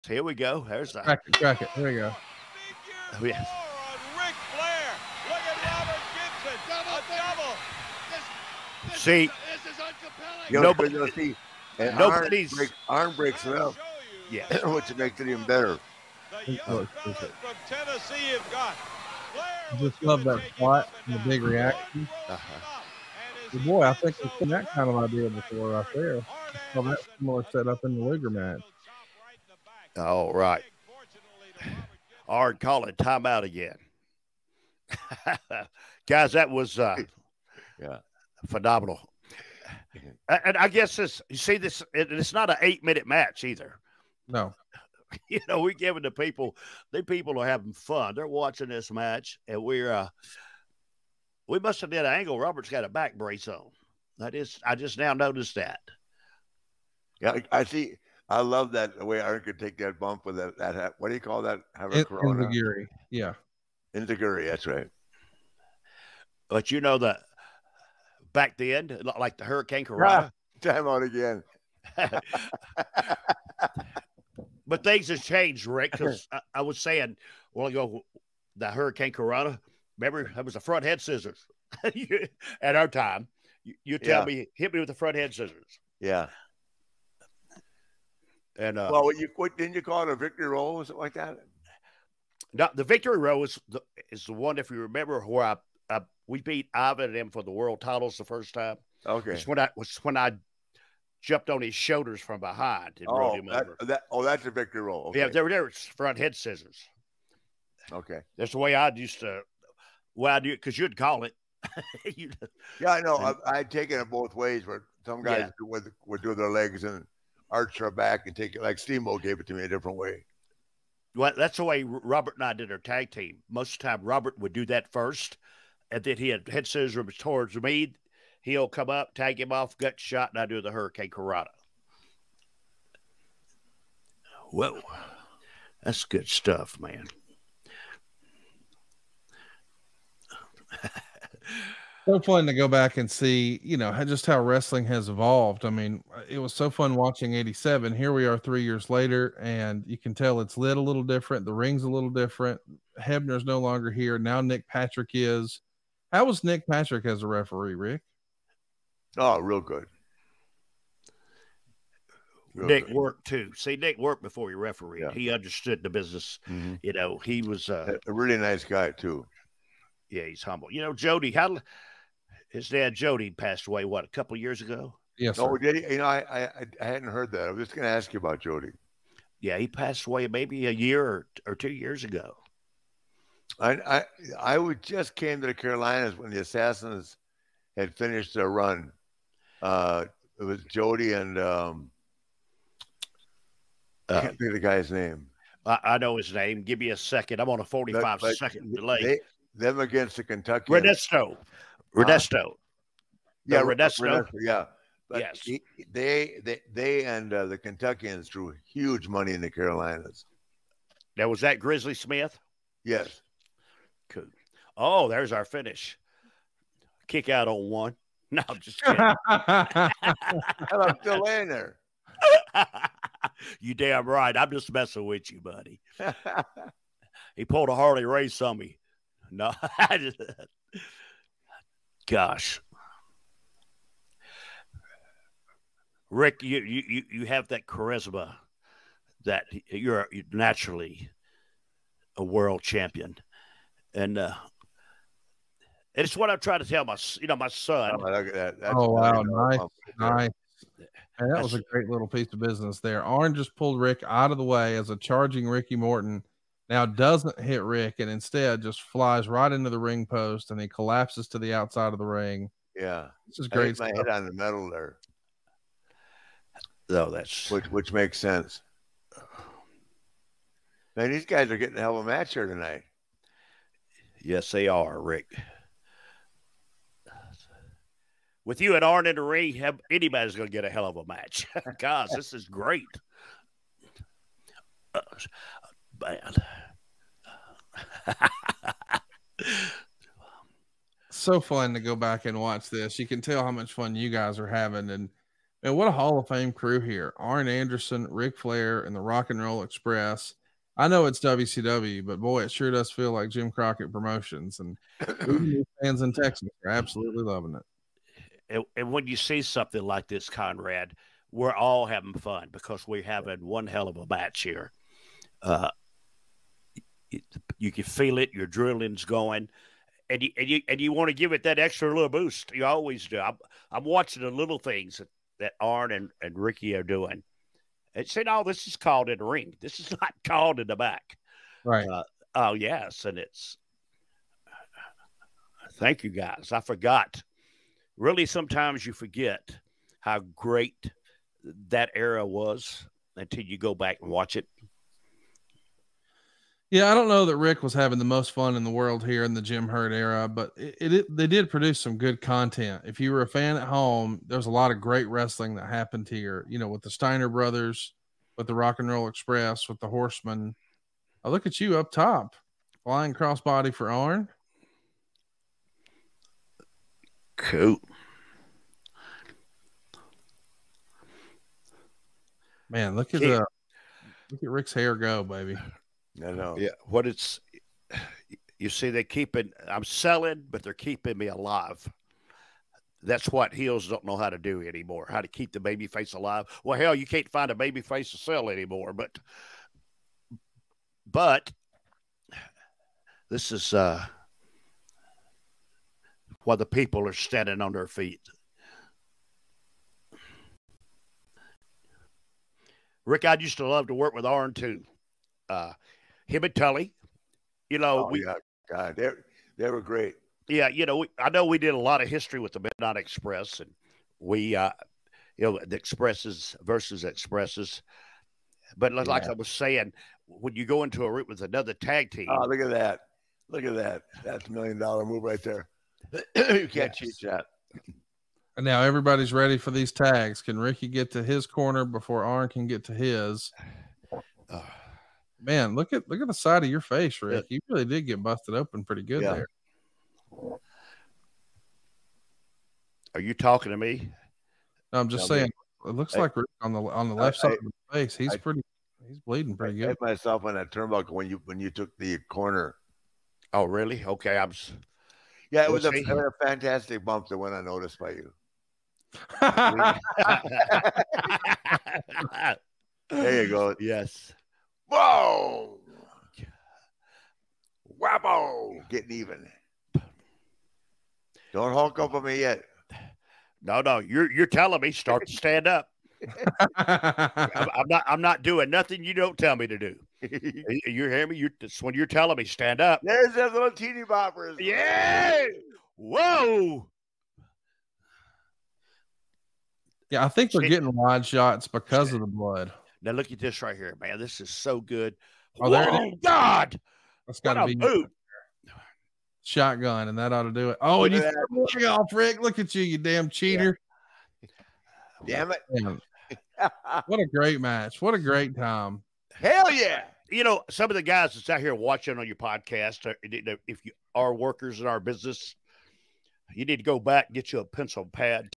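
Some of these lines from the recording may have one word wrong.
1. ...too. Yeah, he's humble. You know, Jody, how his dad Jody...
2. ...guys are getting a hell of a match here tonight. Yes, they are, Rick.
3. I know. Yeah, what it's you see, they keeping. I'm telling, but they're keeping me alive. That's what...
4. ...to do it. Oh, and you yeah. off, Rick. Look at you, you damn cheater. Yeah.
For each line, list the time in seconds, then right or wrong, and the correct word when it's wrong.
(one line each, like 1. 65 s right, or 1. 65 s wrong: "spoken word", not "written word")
1. 168 s right
2. 271 s right
3. 376 s wrong: "selling", not "telling"
4. 500 s right.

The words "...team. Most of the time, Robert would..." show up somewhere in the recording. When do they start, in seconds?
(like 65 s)
123 s.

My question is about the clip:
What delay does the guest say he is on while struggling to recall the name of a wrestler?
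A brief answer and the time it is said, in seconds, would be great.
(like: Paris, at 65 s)
45 second delay, at 197 s.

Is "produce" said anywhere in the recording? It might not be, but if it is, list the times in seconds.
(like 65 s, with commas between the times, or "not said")
351 s.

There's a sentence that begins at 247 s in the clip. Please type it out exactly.
Oh, that, oh wow, nice, nice.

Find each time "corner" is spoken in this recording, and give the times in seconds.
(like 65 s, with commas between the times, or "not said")
431 s, 452 s.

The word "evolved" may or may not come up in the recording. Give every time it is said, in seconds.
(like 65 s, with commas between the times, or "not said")
145 s.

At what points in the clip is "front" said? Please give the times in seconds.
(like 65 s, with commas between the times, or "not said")
80 s, 84 s, 105 s.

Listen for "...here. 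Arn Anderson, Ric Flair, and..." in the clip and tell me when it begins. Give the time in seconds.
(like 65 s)
296 s.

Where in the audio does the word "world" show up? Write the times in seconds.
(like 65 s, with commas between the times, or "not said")
97 s, 242 s, 348 s.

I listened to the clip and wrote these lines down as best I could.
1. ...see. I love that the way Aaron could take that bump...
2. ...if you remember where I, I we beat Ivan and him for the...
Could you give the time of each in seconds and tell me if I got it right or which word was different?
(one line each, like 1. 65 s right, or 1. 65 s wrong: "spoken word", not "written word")
1. 57 s right
2. 94 s right.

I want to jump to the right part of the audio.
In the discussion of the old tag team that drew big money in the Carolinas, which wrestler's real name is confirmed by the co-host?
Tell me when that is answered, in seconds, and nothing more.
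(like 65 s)
211 s.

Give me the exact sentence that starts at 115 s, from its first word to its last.
would would do their legs and arch our back and take it like Steamboat gave it to me a different way.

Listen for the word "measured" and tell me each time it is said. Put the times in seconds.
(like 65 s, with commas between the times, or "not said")
not said.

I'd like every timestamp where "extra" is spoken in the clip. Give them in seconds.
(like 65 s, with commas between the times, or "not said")
321 s.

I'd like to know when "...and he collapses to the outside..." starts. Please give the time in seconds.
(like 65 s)
260 s.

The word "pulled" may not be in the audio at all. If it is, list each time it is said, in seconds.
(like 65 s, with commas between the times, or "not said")
227 s, 253 s.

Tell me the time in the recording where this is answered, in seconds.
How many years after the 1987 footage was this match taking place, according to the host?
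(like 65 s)
148 s.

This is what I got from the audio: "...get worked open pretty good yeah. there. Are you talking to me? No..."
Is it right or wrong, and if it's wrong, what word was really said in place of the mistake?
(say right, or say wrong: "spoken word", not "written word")
wrong: "busted", not "worked".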